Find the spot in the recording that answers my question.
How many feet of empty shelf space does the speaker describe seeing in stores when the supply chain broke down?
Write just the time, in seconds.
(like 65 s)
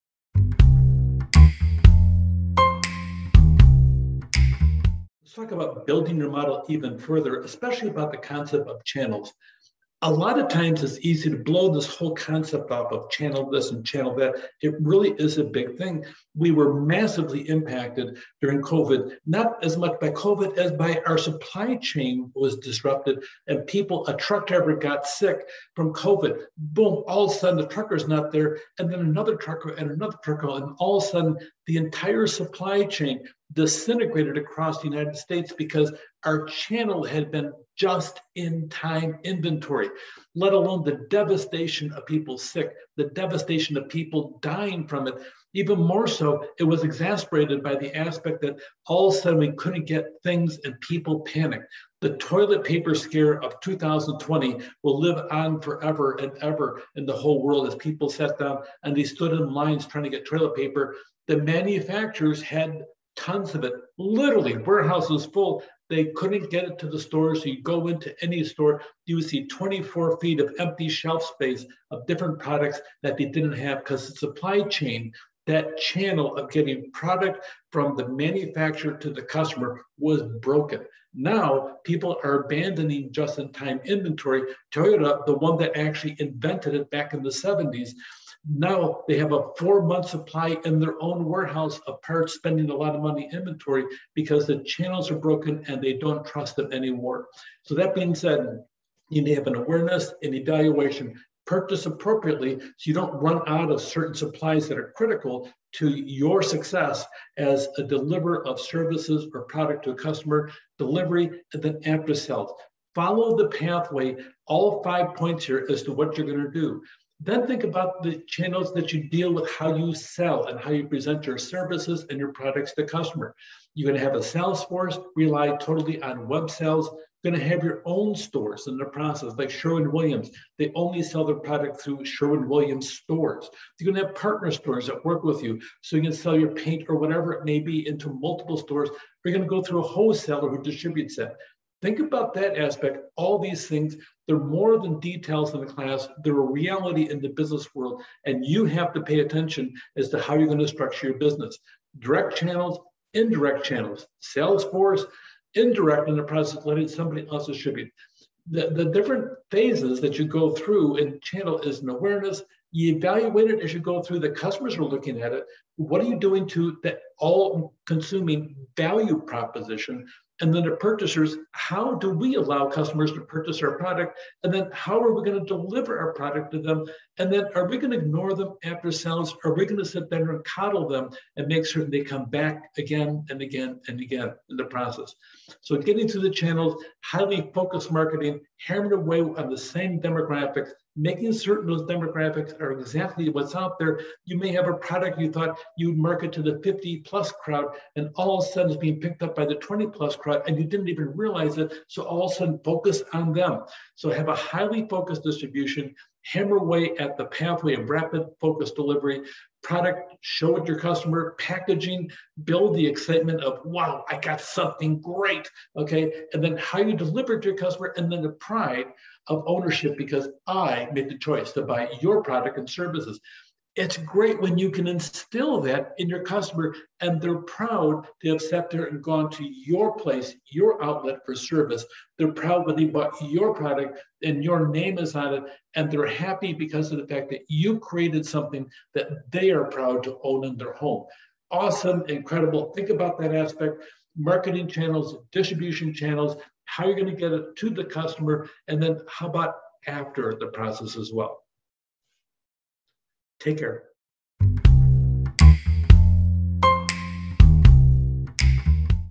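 69 s.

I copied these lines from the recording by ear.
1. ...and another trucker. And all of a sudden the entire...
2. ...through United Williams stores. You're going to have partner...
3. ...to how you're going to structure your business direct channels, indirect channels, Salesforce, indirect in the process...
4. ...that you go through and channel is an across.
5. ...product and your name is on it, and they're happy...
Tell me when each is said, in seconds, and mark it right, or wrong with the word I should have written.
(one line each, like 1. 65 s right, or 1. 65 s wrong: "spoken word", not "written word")
1. 29 s right
2. 131 s wrong: "Sherwin", not "United"
3. 150 s right
4. 160 s wrong: "awareness", not "across"
5. 233 s right.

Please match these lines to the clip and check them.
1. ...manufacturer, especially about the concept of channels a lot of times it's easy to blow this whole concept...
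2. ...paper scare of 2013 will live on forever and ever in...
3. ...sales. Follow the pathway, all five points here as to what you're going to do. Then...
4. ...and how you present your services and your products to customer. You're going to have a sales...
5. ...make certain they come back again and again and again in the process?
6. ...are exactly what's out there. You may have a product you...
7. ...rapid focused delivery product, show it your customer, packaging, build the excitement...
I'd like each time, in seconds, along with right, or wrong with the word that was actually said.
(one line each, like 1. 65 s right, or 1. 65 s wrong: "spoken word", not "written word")
1. 6 s wrong: "further", not "manufacturer"
2. 52 s wrong: "2020", not "2013"
3. 112 s right
4. 120 s right
5. 181 s right
6. 192 s right
7. 207 s right.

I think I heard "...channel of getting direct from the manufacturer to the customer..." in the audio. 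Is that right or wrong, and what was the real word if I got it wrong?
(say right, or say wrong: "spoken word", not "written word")
wrong: "product", not "direct".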